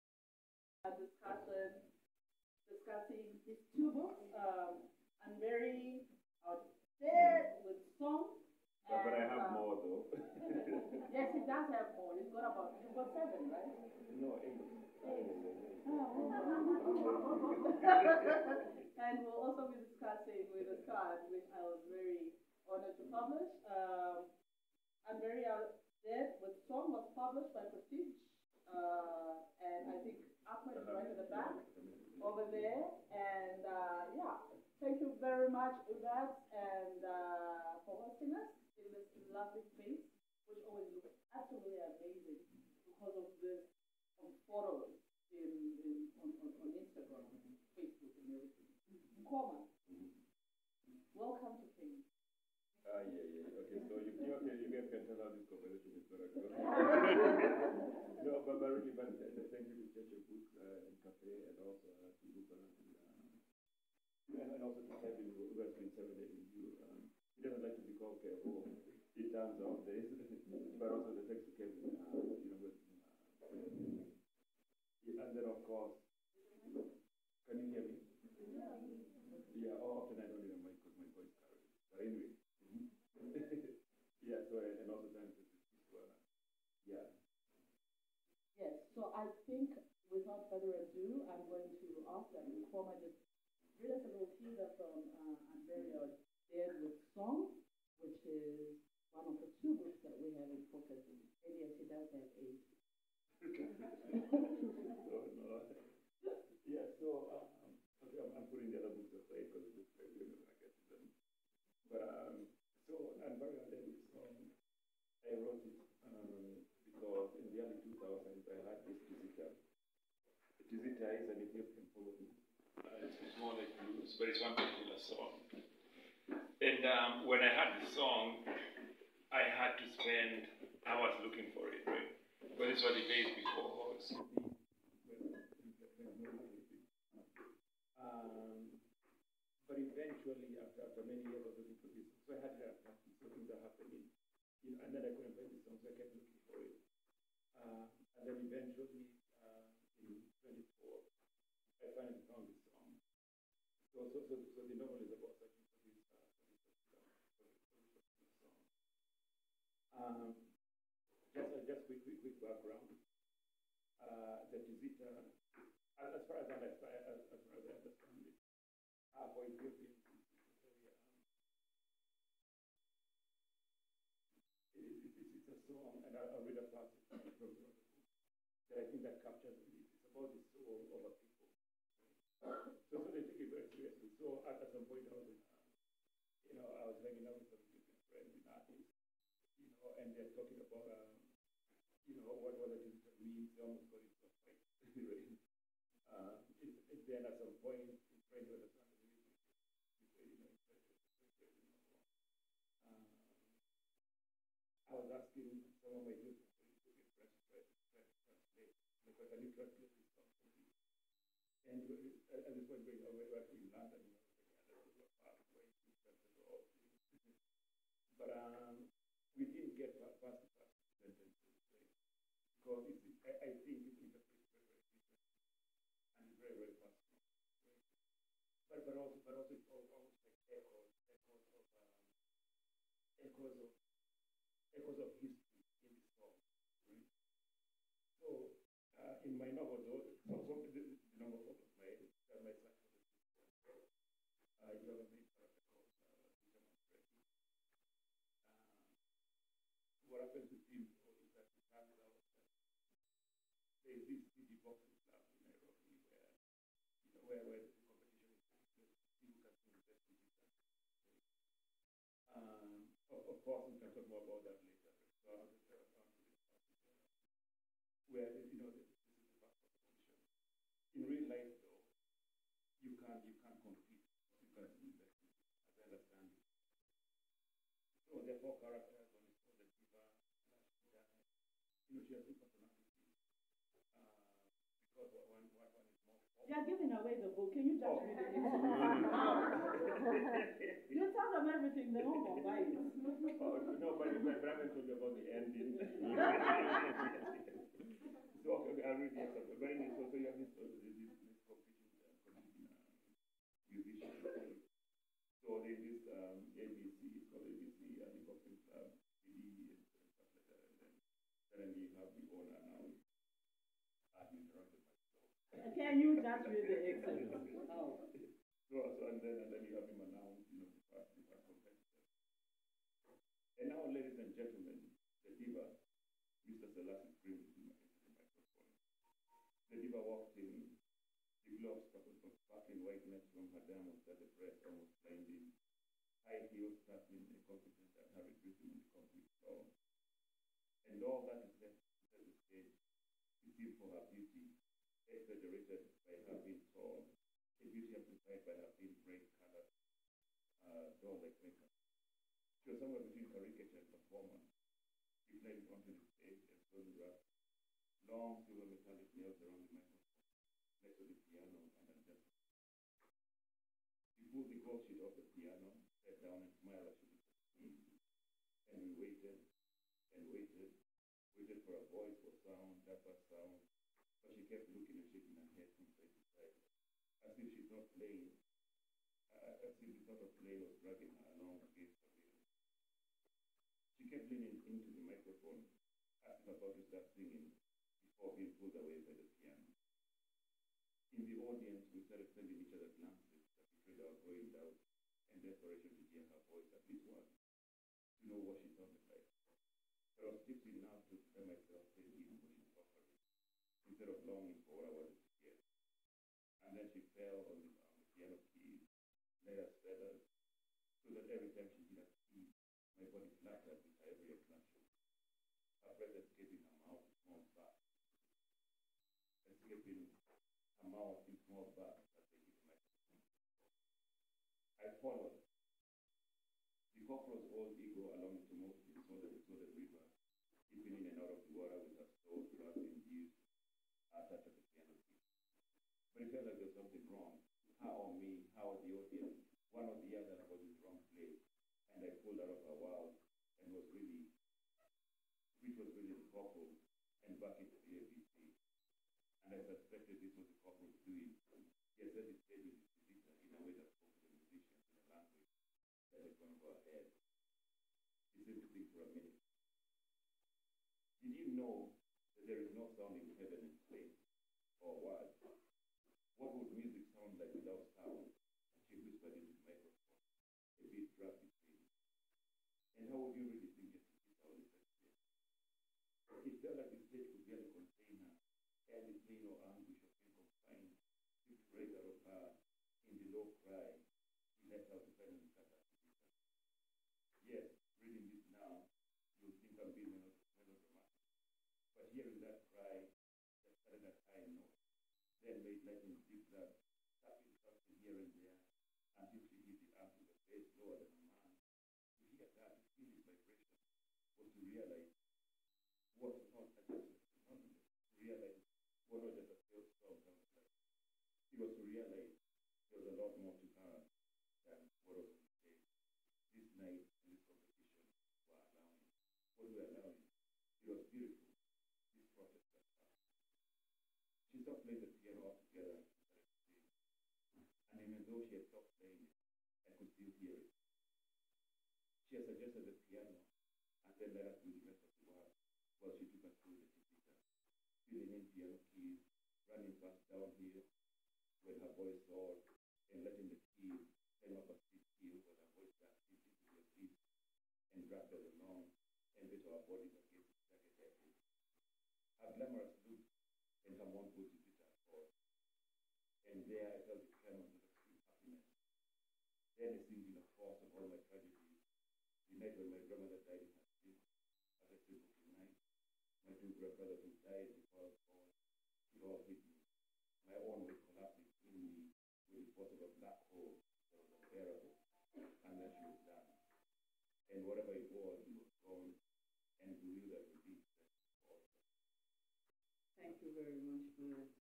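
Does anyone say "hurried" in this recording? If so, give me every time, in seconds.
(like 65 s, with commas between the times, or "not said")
338 s.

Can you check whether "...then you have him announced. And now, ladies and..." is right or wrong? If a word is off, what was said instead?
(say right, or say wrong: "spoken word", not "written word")
right.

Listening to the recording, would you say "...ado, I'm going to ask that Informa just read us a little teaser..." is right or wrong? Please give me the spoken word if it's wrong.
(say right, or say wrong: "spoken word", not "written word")
right.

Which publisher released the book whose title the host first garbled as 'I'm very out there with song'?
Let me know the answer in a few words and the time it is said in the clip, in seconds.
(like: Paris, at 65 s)
Prestige, at 27 s.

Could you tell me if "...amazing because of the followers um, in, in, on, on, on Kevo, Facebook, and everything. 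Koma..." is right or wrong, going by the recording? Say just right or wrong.
wrong.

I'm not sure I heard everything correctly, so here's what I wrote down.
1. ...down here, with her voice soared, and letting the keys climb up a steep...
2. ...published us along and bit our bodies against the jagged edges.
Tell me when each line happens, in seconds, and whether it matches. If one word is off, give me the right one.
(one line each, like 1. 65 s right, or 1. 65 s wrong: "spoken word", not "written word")
1. 540 s right
2. 548 s wrong: "dragged", not "published".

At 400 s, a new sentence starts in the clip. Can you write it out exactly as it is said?
But I was tipsy enough to prepare myself daily in what she offering, instead of longing for what I wanted to hear.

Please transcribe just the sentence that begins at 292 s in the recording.
Oh, no, but my brother told about the ending.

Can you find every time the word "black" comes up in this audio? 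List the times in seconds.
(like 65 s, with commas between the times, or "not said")
332 s, 573 s.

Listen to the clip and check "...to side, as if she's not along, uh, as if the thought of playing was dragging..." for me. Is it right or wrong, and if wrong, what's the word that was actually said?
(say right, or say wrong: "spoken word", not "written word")
wrong: "playing", not "along".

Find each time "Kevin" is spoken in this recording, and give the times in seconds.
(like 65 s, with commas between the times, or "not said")
65 s, 71 s.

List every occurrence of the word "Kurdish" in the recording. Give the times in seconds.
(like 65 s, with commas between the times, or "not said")
not said.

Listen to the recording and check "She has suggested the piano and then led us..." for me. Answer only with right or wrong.
right.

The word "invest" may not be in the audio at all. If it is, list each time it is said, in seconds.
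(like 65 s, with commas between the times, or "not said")
274 s.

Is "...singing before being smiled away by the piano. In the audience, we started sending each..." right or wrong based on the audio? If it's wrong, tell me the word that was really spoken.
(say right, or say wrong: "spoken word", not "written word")
wrong: "pulled", not "smiled".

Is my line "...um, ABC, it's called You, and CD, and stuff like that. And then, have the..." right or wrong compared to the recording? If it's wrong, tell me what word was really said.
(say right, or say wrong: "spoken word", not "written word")
wrong: "ABC", not "You".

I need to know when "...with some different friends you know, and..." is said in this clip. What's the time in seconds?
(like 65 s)
187 s.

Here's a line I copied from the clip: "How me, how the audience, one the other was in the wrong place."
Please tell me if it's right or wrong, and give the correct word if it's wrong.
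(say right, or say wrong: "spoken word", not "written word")
right.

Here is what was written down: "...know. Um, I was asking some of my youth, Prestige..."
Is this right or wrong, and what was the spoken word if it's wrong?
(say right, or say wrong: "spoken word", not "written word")
wrong: "And", not "Prestige".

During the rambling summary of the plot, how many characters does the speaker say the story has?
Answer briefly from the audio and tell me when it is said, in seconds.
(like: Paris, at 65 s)
4, at 278 s.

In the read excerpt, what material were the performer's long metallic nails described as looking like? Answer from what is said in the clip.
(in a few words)
silver.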